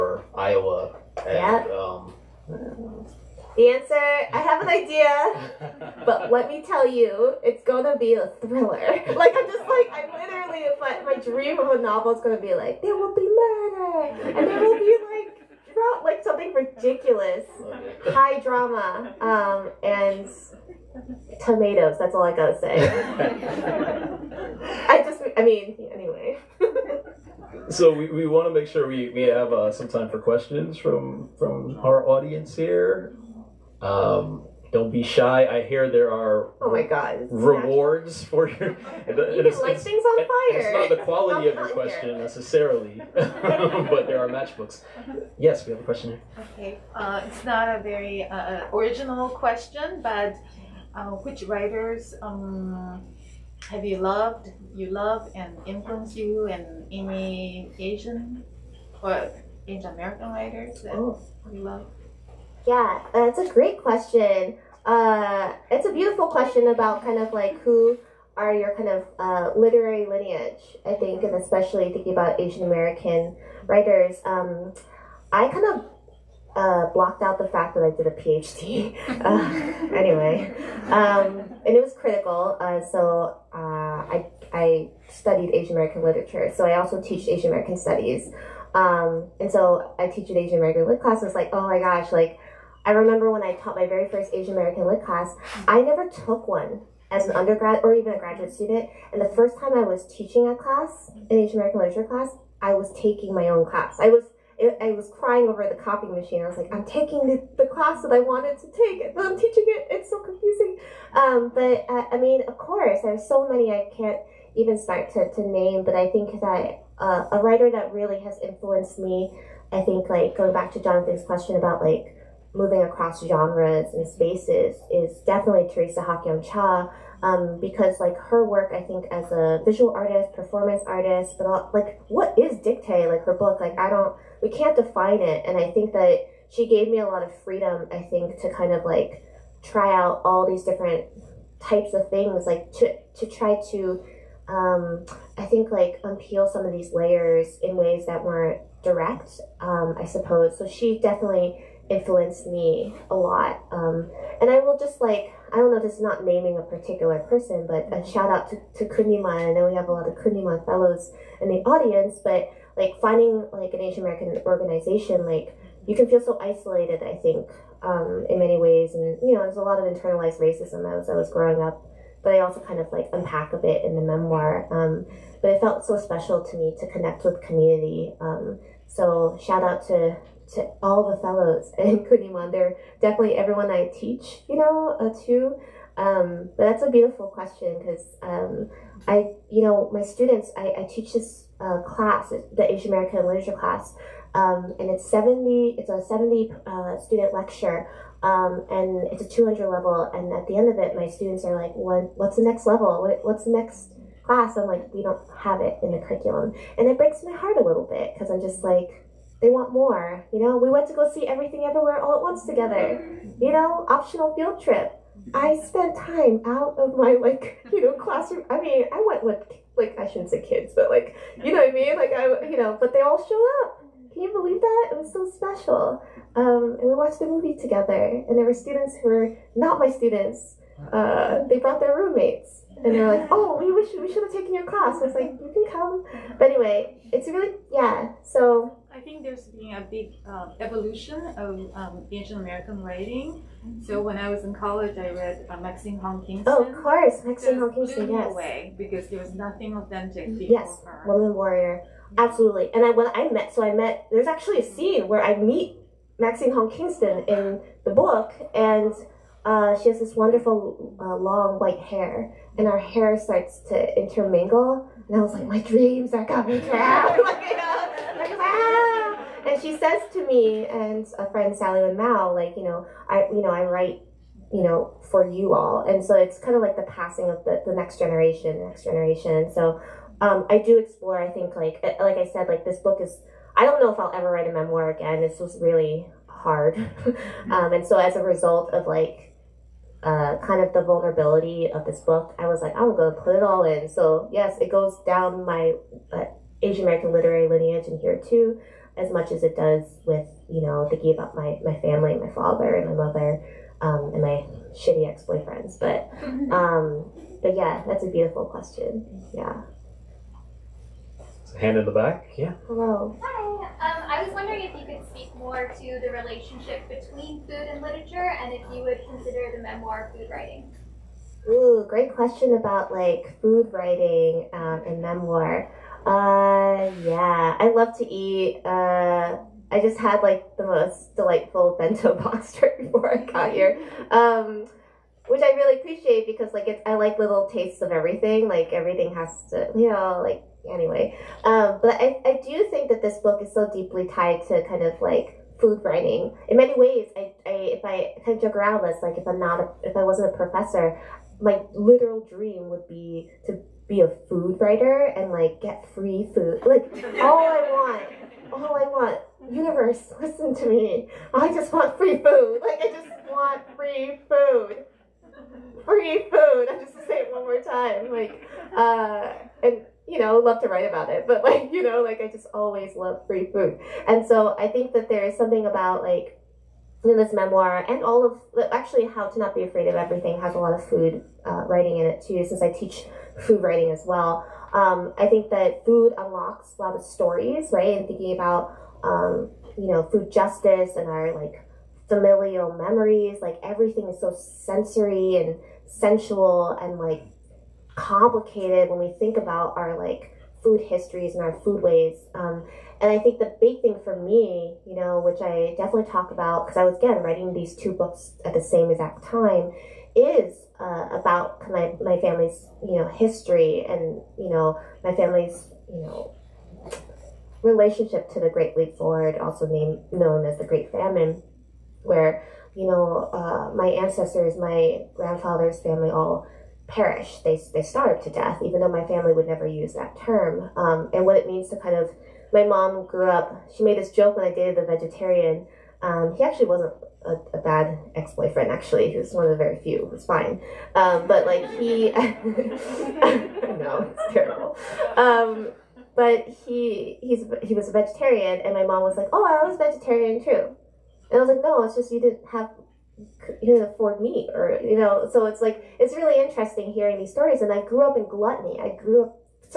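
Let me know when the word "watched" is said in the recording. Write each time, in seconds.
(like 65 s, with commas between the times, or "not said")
226 s.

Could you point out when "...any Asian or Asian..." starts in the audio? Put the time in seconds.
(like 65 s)
56 s.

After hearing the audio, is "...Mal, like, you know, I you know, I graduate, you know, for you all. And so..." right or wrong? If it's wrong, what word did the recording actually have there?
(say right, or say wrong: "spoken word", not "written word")
wrong: "write", not "graduate".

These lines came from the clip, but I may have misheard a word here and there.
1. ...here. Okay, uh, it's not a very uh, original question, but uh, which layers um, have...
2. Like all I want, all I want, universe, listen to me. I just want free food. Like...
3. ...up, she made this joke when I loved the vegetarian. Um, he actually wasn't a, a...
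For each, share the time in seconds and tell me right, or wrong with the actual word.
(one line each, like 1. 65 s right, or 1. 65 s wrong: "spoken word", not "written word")
1. 46 s wrong: "writers", not "layers"
2. 356 s right
3. 433 s wrong: "dated", not "loved".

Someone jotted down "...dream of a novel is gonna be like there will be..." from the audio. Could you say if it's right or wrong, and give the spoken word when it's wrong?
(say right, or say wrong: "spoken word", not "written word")
right.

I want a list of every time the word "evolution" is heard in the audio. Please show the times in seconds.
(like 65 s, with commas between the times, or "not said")
240 s.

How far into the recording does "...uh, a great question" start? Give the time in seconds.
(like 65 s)
63 s.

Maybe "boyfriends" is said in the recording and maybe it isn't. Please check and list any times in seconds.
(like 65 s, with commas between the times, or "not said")
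305 s, 438 s.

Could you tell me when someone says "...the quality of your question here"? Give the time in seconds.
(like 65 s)
40 s.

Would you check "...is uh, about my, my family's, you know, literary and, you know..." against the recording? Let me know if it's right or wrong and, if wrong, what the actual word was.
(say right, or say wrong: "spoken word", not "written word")
wrong: "history", not "literary".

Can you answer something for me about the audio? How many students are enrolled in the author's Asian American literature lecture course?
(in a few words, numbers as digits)
70.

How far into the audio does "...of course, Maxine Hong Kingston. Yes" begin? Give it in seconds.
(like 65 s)
246 s.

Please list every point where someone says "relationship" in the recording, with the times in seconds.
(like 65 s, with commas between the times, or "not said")
316 s, 417 s.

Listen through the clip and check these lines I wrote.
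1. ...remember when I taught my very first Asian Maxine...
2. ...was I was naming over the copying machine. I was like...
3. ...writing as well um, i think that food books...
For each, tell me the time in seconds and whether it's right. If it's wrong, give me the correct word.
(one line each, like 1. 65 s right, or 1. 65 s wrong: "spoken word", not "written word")
1. 92 s wrong: "American", not "Maxine"
2. 104 s wrong: "crying", not "naming"
3. 383 s wrong: "unlocks", not "books".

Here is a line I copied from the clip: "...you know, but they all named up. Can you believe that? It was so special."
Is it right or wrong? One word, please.
wrong.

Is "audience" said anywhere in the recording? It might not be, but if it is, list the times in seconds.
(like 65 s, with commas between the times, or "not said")
32 s, 161 s.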